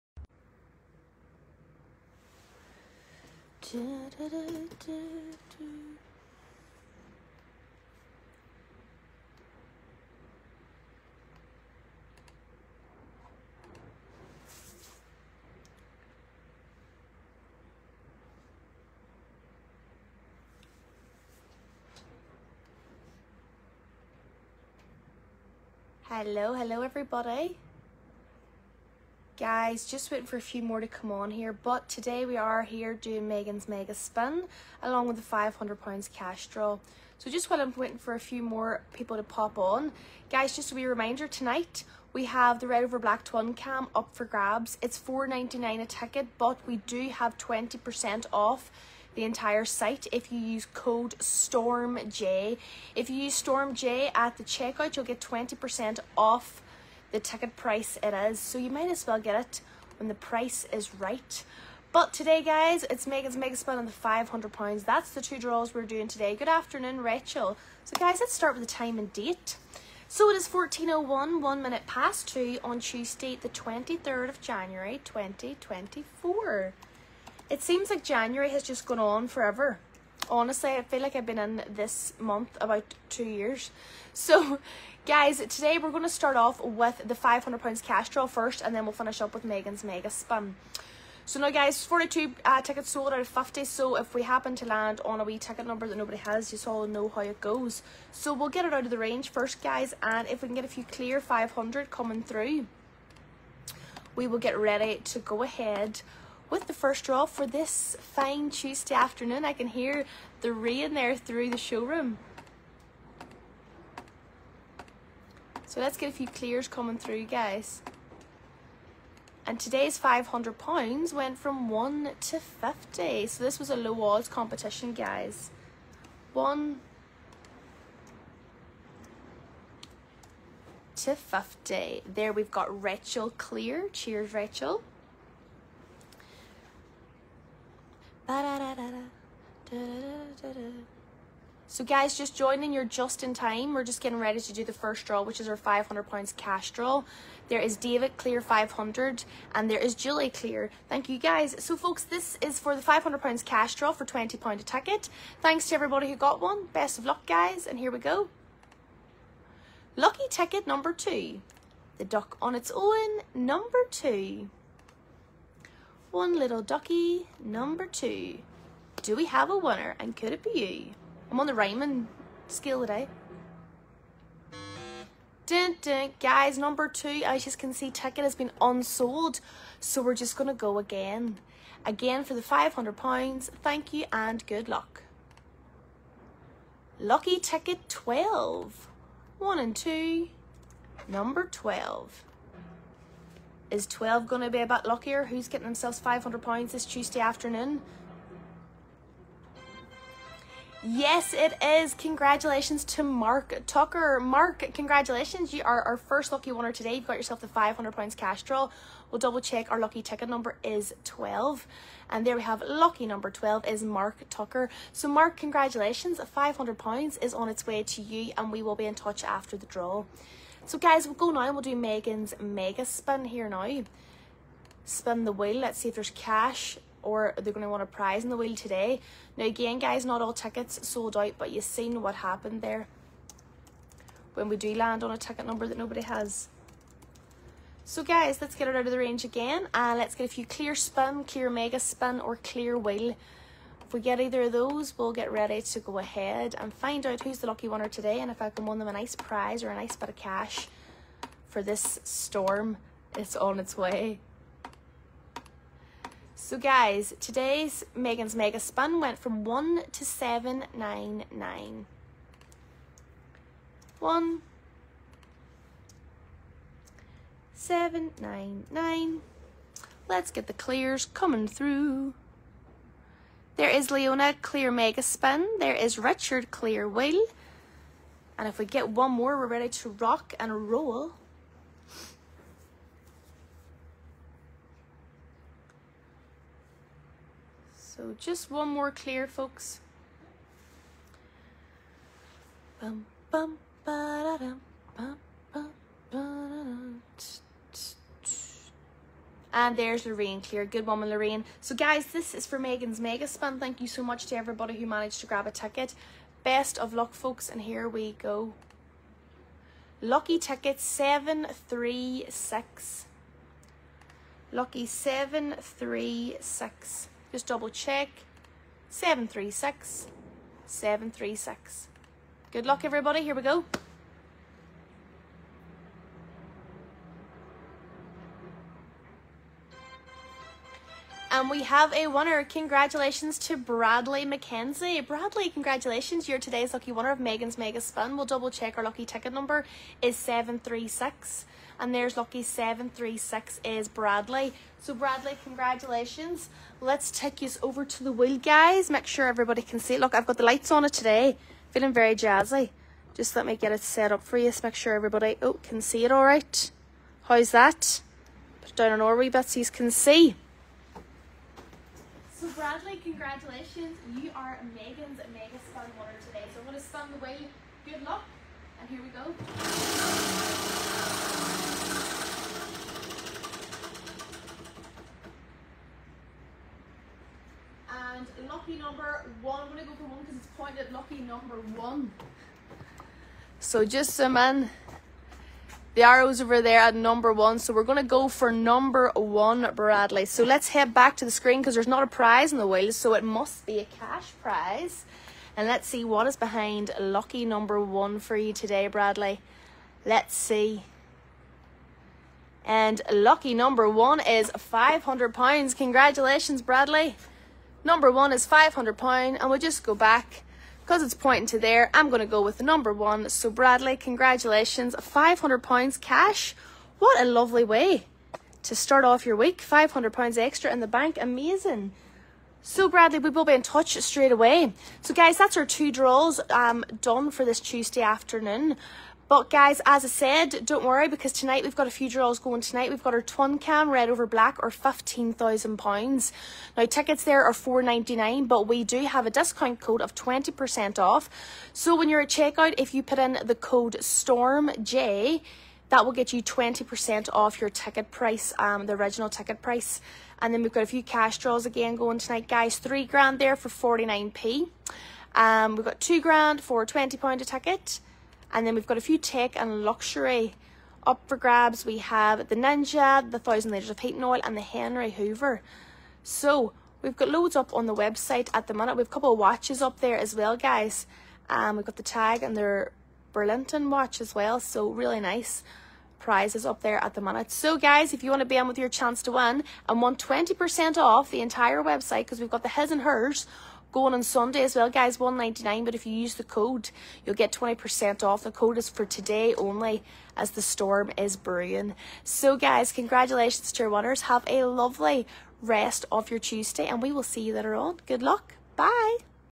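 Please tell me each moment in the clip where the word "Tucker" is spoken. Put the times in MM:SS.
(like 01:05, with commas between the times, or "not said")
03:23, 03:34.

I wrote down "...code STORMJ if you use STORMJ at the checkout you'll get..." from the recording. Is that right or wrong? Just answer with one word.
right.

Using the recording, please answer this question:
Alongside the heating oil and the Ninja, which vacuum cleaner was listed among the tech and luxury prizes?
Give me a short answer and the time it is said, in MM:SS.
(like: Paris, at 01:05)
Henry Hoover, at 07:44.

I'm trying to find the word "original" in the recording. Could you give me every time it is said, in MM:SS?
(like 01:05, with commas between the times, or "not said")
07:28.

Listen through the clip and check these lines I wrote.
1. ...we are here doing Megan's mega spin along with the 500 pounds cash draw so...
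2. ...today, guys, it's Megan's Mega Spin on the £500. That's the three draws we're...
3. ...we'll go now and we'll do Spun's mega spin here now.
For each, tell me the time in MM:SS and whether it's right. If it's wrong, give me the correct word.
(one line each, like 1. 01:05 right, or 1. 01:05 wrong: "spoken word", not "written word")
1. 00:32 right
2. 01:02 wrong: "two", not "three"
3. 03:41 wrong: "Megan", not "Spun".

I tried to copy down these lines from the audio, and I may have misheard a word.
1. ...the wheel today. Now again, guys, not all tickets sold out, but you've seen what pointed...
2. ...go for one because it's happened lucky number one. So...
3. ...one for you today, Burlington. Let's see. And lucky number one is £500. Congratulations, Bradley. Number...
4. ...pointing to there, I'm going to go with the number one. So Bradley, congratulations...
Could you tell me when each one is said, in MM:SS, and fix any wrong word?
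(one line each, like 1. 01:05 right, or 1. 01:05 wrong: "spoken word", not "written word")
1. 03:48 wrong: "happened", not "pointed"
2. 06:19 wrong: "pointed", not "happened"
3. 06:37 wrong: "Bradley", not "Burlington"
4. 06:51 right.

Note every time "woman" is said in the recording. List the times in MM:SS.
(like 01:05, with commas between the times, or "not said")
05:00.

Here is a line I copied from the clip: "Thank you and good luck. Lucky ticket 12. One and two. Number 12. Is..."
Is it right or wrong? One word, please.
right.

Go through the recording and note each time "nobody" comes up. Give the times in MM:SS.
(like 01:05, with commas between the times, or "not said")
01:35, 03:55.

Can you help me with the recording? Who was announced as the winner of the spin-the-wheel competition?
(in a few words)
Bradley McKenzie.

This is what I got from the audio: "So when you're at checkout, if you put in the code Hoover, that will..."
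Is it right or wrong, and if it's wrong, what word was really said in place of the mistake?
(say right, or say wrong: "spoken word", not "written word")
wrong: "STORMJ", not "Hoover".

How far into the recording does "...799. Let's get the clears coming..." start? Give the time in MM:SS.
04:27.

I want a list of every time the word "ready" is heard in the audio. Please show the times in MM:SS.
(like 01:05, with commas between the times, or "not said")
01:44, 02:24, 04:05, 04:39.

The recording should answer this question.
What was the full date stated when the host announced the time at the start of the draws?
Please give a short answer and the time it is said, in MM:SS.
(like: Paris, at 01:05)
Tuesday 23 January 2024, at 01:12.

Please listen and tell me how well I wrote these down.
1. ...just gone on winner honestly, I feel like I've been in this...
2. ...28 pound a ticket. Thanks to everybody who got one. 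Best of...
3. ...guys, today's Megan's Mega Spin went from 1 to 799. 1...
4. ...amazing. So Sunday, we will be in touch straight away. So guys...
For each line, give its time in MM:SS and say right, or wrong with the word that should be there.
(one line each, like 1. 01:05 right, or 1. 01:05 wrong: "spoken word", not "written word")
1. 01:18 wrong: "forever", not "winner"
2. 02:34 wrong: "20", not "28"
3. 04:16 right
4. 07:01 wrong: "Bradley", not "Sunday".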